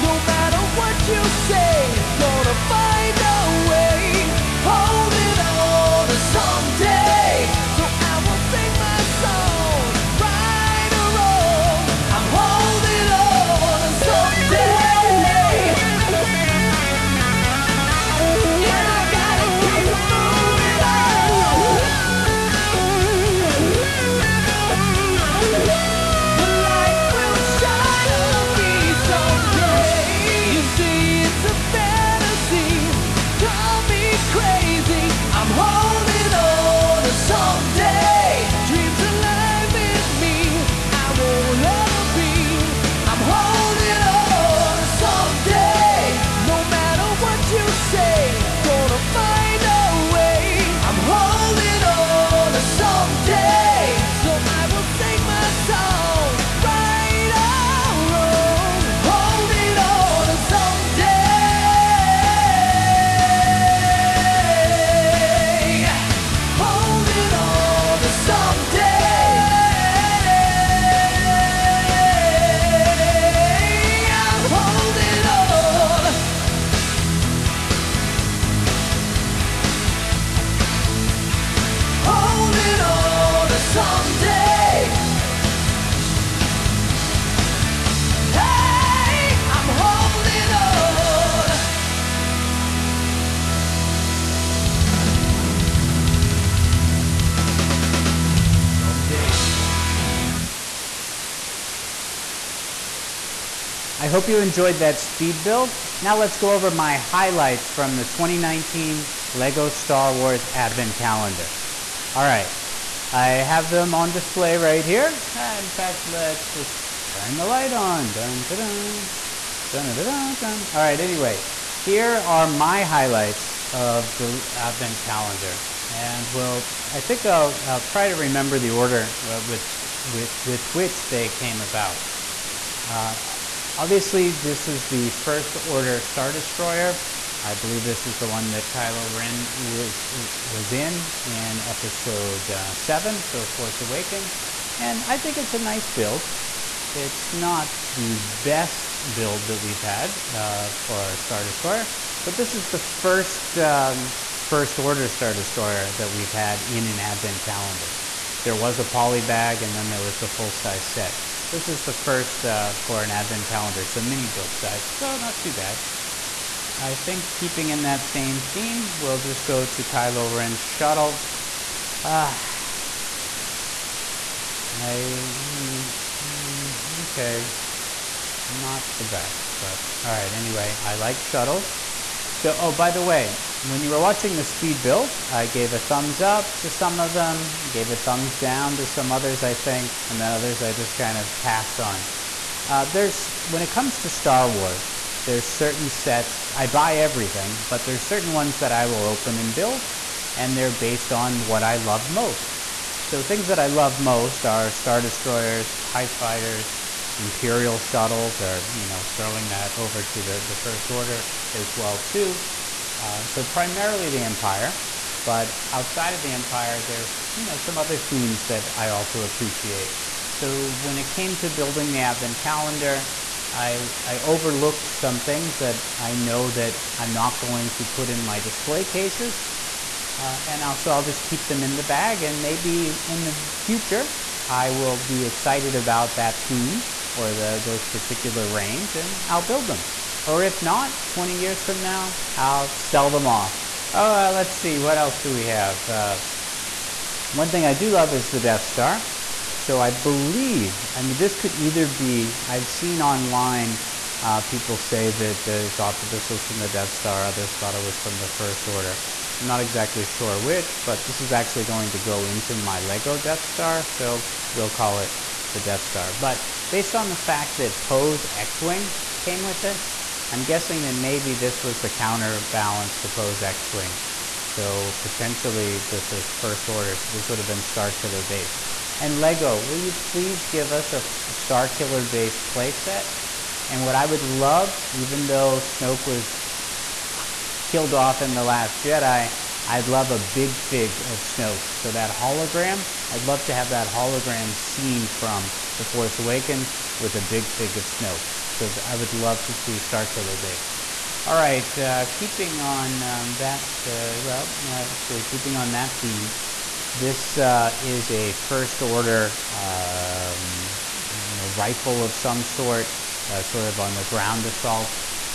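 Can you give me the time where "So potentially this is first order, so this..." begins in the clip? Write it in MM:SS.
04:34.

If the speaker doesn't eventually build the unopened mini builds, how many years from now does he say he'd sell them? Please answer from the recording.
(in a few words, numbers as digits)
20.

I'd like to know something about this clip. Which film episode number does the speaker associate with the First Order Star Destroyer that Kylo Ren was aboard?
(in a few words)
7.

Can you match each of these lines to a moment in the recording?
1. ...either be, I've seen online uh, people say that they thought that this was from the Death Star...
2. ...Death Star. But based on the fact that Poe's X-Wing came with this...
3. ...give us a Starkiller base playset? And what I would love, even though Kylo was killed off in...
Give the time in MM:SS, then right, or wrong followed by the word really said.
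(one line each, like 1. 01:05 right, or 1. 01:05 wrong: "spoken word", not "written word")
1. 04:11 right
2. 04:25 right
3. 04:40 wrong: "Snoke", not "Kylo".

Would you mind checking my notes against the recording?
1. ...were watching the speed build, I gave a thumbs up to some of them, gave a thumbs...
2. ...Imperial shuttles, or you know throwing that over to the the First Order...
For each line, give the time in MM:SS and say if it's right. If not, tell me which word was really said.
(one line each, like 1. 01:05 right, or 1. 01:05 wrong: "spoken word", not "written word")
1. 03:03 right
2. 03:27 right.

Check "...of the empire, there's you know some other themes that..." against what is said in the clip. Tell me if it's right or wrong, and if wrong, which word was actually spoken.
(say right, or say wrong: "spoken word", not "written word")
right.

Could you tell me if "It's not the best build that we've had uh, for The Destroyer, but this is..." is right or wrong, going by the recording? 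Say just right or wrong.
wrong.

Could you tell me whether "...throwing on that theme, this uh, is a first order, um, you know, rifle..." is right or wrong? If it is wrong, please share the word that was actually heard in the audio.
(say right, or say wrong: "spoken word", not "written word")
wrong: "keeping", not "throwing".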